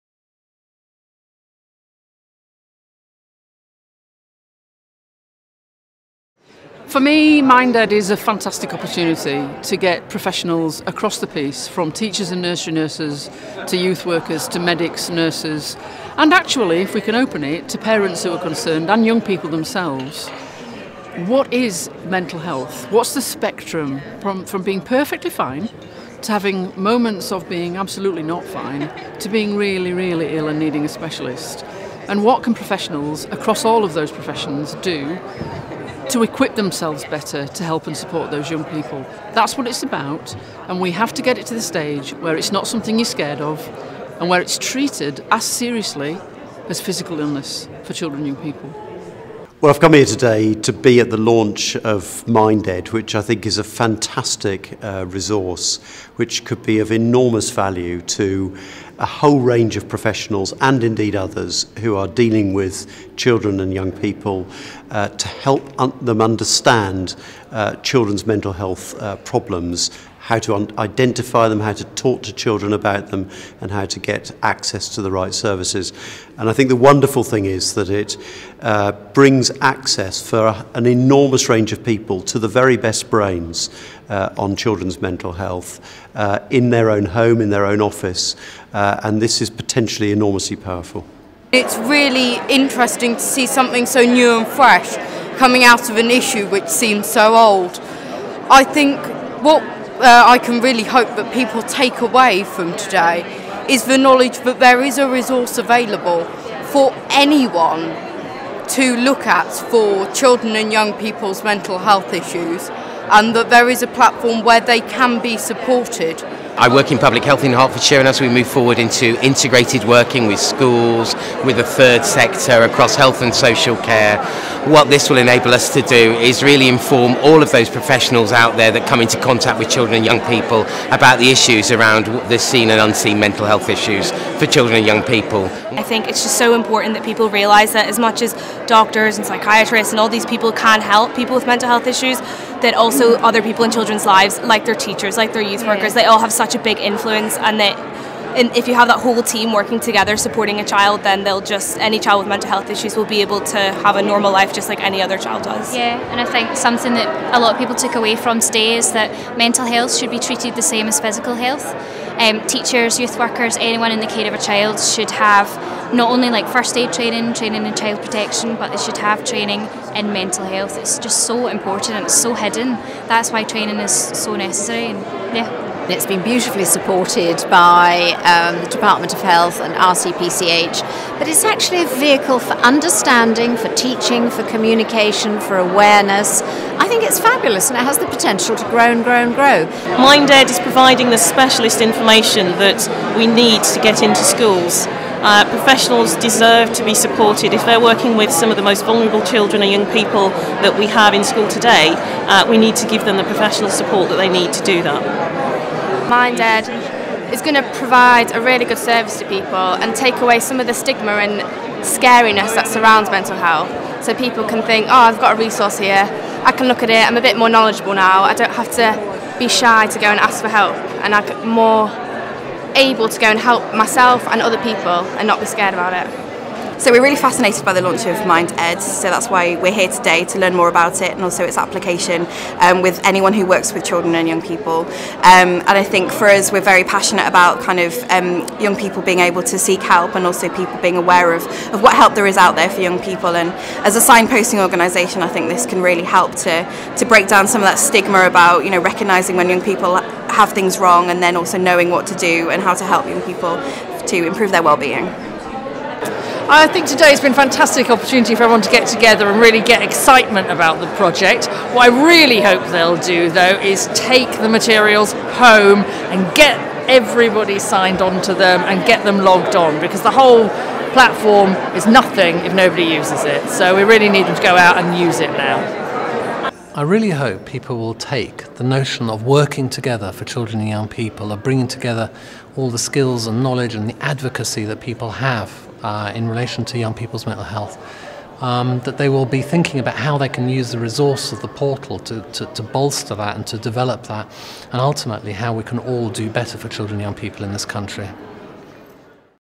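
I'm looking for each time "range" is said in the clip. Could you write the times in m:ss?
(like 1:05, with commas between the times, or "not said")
0:59, 1:21.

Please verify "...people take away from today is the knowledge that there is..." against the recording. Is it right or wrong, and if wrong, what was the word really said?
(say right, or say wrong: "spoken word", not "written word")
right.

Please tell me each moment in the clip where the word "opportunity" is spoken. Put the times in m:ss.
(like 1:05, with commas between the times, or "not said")
0:08, 4:17.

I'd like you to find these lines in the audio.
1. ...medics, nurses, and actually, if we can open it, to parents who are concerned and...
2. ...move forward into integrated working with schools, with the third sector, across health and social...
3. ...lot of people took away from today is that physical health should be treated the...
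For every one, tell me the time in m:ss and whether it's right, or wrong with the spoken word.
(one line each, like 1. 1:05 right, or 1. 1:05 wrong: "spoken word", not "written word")
1. 0:14 right
2. 1:58 right
3. 2:37 wrong: "mental", not "physical".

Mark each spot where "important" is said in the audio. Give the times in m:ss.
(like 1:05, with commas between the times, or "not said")
2:16, 2:51.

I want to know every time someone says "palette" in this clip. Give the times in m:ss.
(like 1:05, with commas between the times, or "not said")
not said.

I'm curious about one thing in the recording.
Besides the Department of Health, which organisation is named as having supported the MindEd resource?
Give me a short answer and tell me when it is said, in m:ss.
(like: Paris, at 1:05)
RCPCH, at 2:59.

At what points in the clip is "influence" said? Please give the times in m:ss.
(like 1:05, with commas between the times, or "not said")
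2:26.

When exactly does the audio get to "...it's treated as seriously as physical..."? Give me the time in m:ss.
0:44.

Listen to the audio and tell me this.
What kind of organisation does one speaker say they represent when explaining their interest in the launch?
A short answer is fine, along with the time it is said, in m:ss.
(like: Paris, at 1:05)
Signposting organisation, at 4:03.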